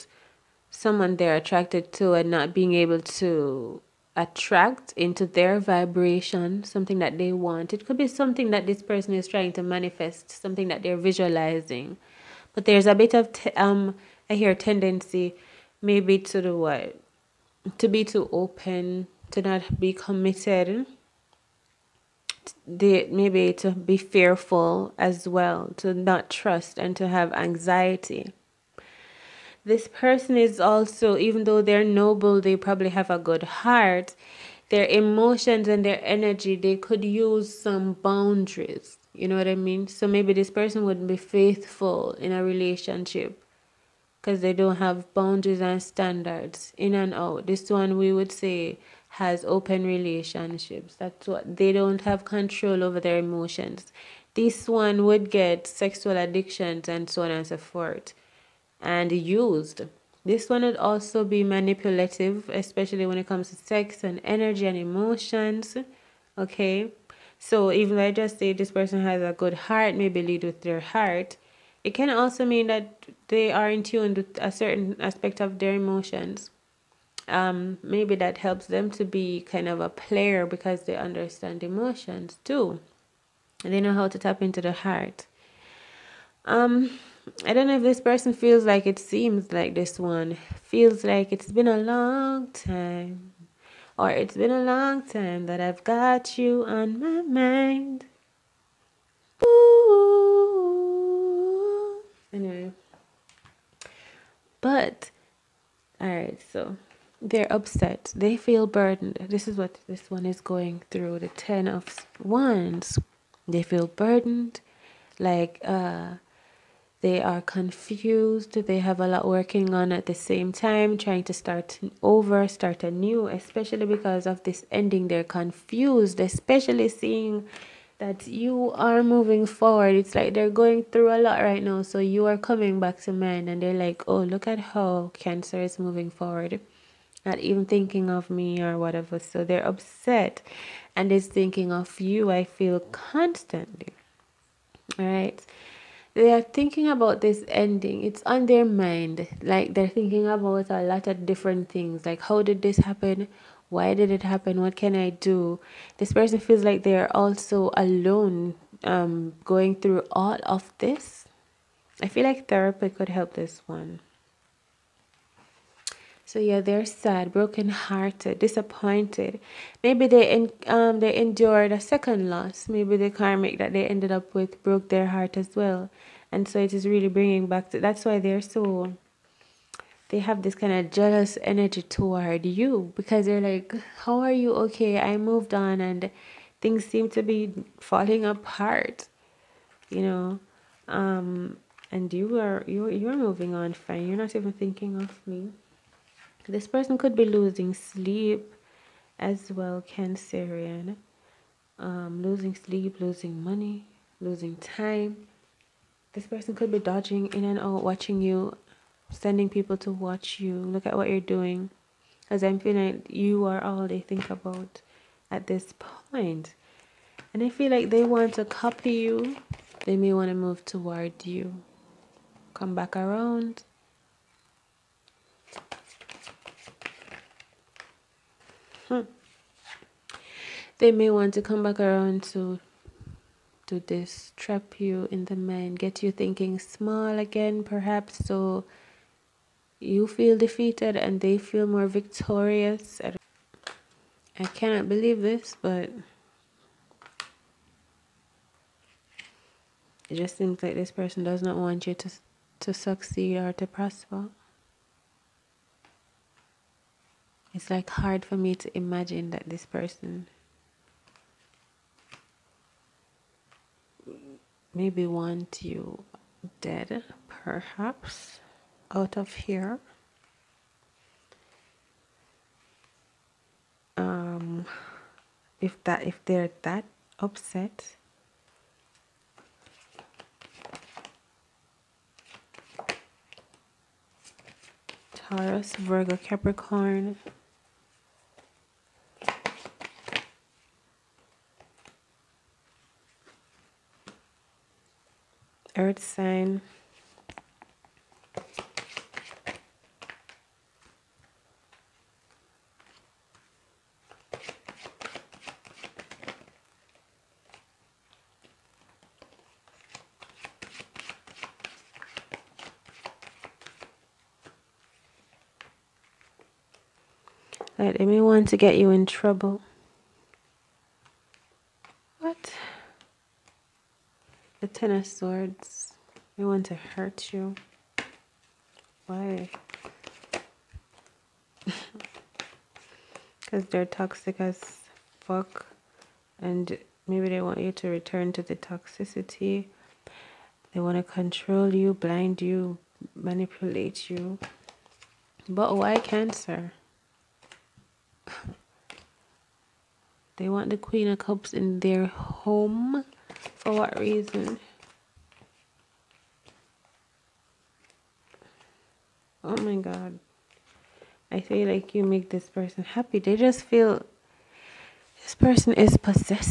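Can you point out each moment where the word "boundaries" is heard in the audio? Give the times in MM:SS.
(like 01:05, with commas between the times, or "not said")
00:37, 00:45.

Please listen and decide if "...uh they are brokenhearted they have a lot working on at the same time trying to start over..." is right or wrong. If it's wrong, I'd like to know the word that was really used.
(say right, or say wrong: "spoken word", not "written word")
wrong: "confused", not "brokenhearted".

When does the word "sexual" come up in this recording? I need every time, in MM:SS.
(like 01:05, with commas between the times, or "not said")
00:55.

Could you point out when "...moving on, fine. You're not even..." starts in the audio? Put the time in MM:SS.
03:13.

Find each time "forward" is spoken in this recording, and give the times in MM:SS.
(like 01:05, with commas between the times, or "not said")
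02:09, 02:16.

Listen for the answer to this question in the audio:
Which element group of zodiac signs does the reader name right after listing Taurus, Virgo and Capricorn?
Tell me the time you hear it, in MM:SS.
04:55.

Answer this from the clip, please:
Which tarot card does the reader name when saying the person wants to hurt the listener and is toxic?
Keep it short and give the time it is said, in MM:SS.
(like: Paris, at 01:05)
Ten of Swords, at 05:24.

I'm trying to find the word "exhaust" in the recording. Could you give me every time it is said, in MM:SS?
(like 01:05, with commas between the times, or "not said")
not said.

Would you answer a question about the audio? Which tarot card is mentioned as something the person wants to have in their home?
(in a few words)
Queen of Cups.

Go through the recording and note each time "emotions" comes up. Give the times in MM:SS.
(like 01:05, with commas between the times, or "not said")
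00:34, 00:53, 01:04, 01:15, 01:21.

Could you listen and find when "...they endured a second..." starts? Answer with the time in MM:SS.
02:50.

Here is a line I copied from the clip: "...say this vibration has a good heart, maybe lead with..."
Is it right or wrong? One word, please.
wrong.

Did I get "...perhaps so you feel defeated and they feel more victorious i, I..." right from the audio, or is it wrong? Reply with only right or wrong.
right.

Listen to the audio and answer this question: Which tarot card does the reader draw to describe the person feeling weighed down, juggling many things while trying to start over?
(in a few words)
10 of Wands.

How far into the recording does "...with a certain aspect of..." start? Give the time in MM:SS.
01:14.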